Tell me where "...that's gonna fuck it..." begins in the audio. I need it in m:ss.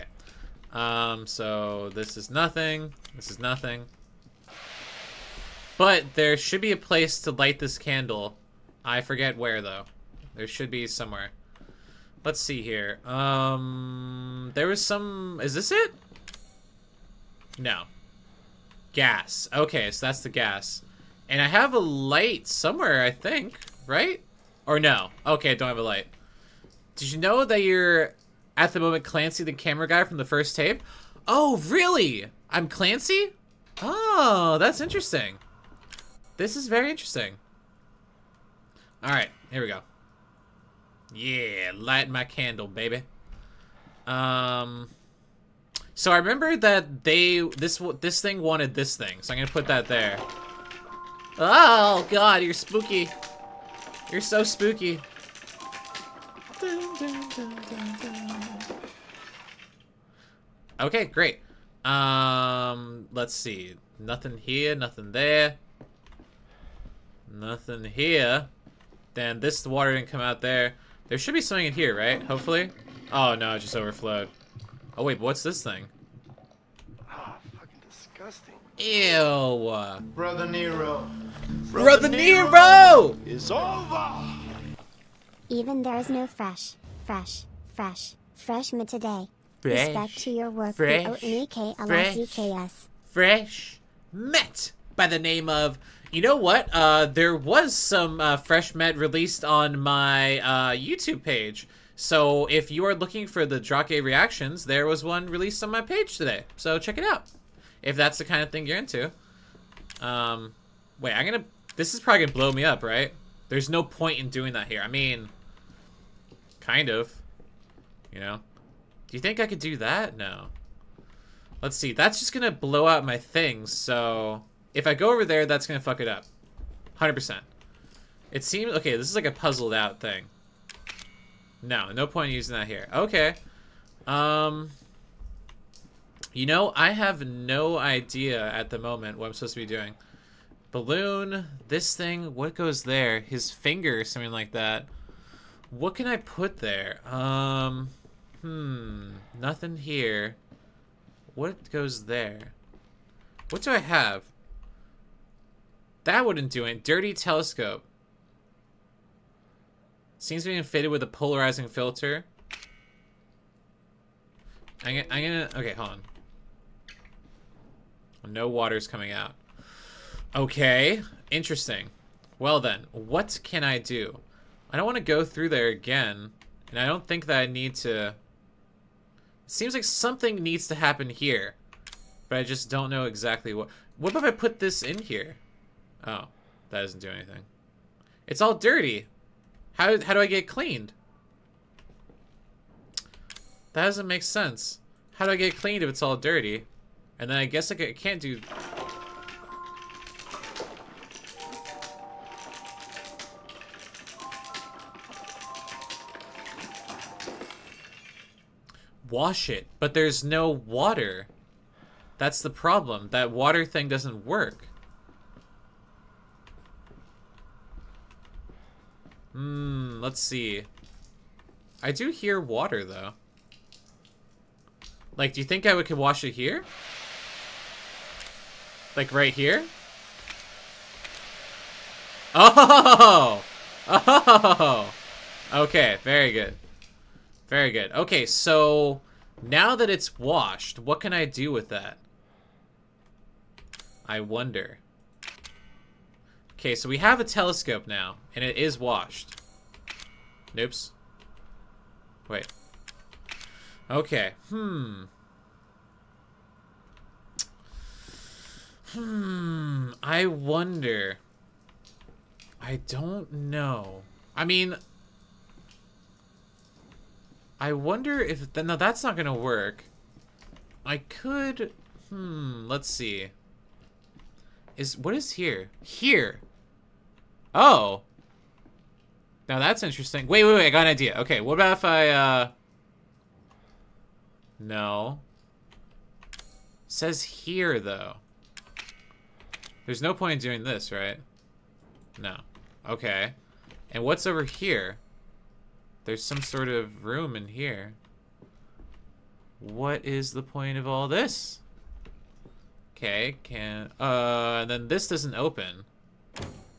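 2:05.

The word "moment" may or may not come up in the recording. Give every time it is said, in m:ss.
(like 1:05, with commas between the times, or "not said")
0:28, 2:18.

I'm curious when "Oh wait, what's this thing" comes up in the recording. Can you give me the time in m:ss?
1:14.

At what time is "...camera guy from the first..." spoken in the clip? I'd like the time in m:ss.
0:29.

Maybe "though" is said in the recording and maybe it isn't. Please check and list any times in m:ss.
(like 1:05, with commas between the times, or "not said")
0:09, 3:42, 4:47.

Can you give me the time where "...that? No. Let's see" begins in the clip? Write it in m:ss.
1:59.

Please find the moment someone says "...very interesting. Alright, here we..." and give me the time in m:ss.
0:36.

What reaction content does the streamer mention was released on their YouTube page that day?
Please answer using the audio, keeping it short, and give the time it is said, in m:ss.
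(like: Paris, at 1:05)
Drake reactions, at 1:43.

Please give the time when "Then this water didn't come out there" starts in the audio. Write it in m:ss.
1:09.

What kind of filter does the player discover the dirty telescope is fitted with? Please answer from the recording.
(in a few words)
Polarizing filter.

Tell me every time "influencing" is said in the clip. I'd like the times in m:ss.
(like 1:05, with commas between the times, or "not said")
not said.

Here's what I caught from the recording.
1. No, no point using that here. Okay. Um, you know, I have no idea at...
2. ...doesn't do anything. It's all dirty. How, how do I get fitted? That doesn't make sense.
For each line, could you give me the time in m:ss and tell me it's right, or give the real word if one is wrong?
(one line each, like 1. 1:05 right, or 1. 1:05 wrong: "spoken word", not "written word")
1. 2:11 right
2. 3:06 wrong: "cleaned", not "fitted".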